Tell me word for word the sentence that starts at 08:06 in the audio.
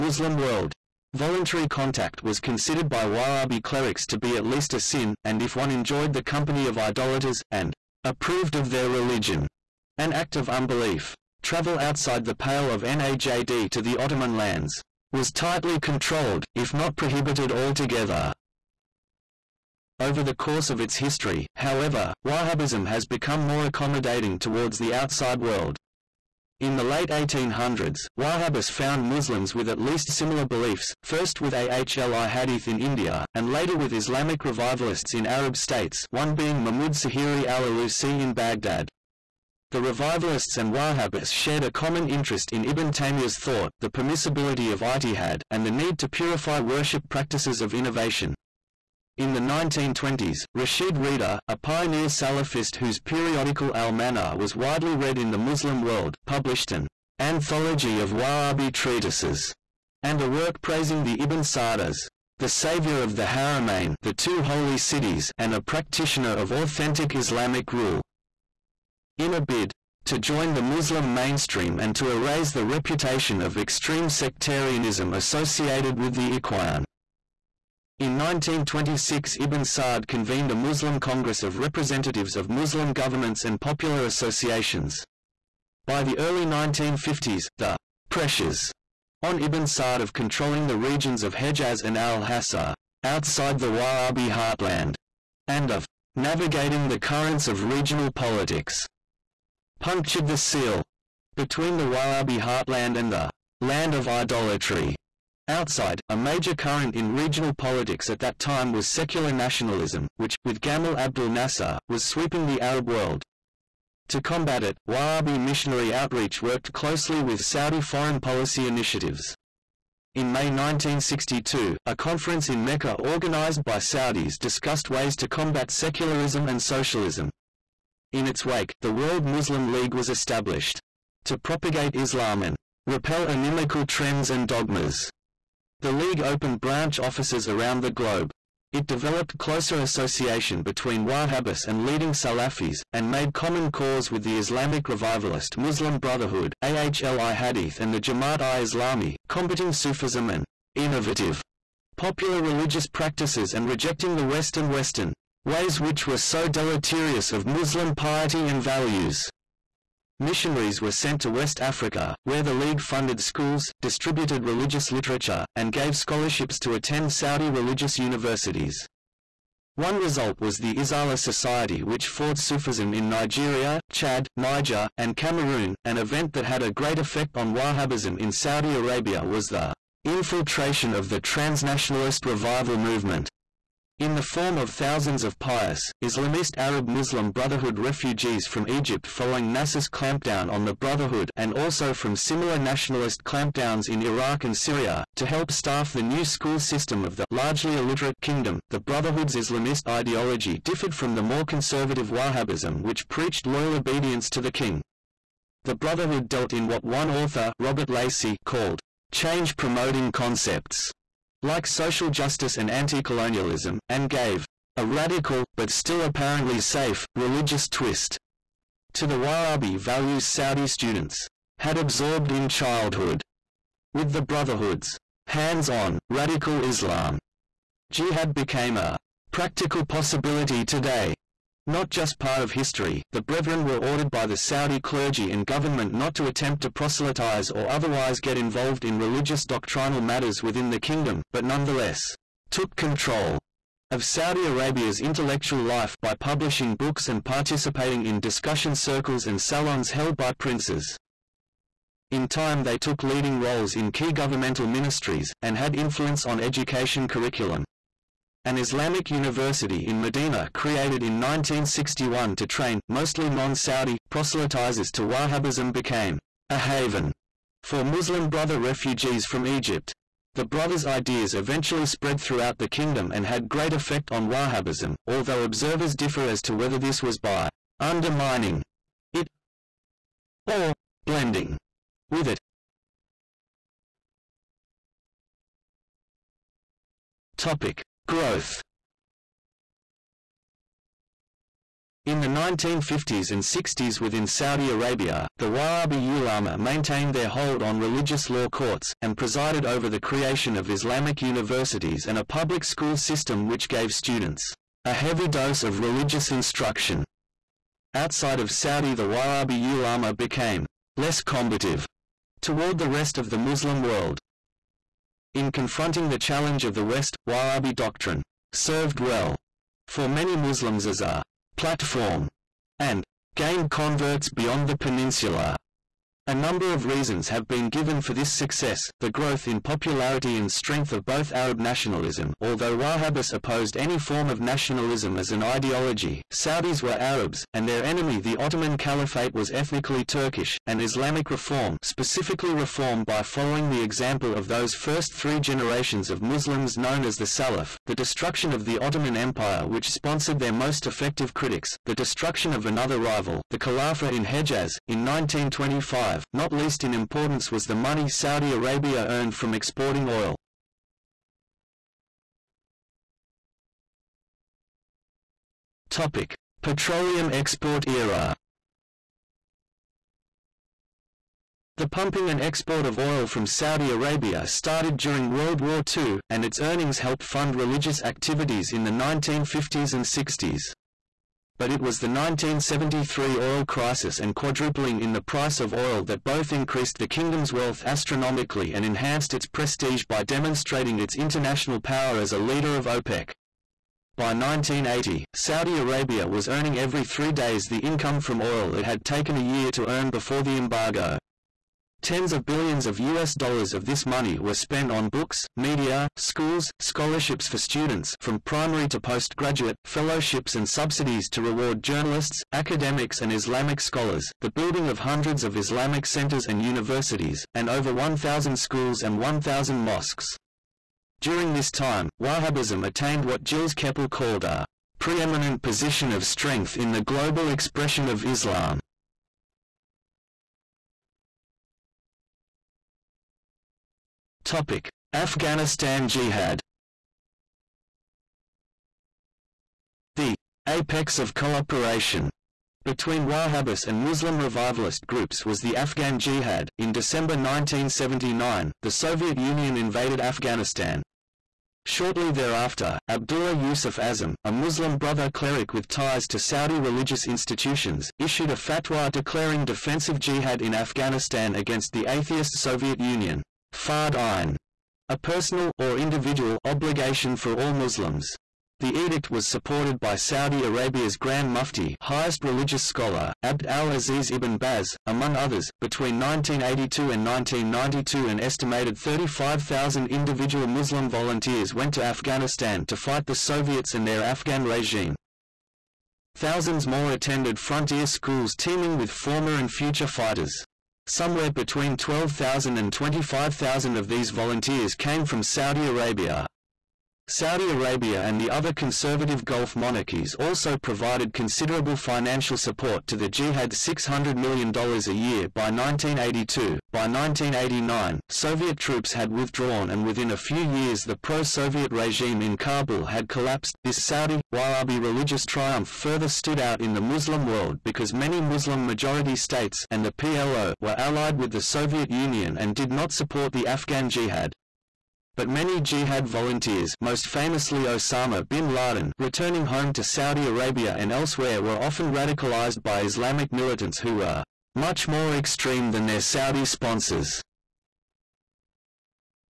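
Thousands more attended frontier schools teeming with former and future fighters.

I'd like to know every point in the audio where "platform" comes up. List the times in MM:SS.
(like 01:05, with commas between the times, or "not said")
05:21.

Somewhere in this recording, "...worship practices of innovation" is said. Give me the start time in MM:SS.
00:46.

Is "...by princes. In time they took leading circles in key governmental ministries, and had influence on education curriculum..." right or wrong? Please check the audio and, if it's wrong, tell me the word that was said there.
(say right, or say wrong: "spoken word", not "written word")
wrong: "roles", not "circles".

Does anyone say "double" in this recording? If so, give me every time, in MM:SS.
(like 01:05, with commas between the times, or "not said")
not said.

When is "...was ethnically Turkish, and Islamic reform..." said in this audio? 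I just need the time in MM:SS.
05:39.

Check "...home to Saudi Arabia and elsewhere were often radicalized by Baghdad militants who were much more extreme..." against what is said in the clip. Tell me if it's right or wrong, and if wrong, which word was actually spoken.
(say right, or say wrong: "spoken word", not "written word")
wrong: "Islamic", not "Baghdad".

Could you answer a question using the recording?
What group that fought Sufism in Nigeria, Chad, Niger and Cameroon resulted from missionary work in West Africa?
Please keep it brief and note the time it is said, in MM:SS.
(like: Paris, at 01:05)
Izala Society, at 02:50.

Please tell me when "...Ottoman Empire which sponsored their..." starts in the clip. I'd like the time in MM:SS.
05:48.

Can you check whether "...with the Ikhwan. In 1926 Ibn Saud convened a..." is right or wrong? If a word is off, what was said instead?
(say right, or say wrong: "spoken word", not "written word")
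right.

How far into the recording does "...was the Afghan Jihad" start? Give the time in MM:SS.
07:25.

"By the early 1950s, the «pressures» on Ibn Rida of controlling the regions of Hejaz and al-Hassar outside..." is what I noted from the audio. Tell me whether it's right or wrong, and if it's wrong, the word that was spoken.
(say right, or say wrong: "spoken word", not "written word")
wrong: "Saud", not "Rida".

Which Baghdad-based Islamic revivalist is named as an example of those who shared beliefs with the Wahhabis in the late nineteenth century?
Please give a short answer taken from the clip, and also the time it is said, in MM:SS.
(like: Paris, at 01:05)
Mahmud Sahiri al-Alusi, at 00:36.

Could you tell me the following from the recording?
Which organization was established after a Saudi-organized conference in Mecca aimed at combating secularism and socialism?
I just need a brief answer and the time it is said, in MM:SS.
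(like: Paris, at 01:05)
World Muslim League, at 02:08.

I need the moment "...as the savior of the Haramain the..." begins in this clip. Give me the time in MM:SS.
01:01.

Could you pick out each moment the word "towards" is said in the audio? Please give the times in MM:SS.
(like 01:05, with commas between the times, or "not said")
00:24, 05:12.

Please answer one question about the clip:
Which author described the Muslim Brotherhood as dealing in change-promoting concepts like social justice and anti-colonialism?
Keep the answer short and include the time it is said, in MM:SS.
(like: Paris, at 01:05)
Robert Lacey, at 03:27.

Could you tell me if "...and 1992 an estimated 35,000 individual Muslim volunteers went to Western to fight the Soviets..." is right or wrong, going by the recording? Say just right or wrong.
wrong.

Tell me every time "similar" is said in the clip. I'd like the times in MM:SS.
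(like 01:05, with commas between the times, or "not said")
00:30, 03:12.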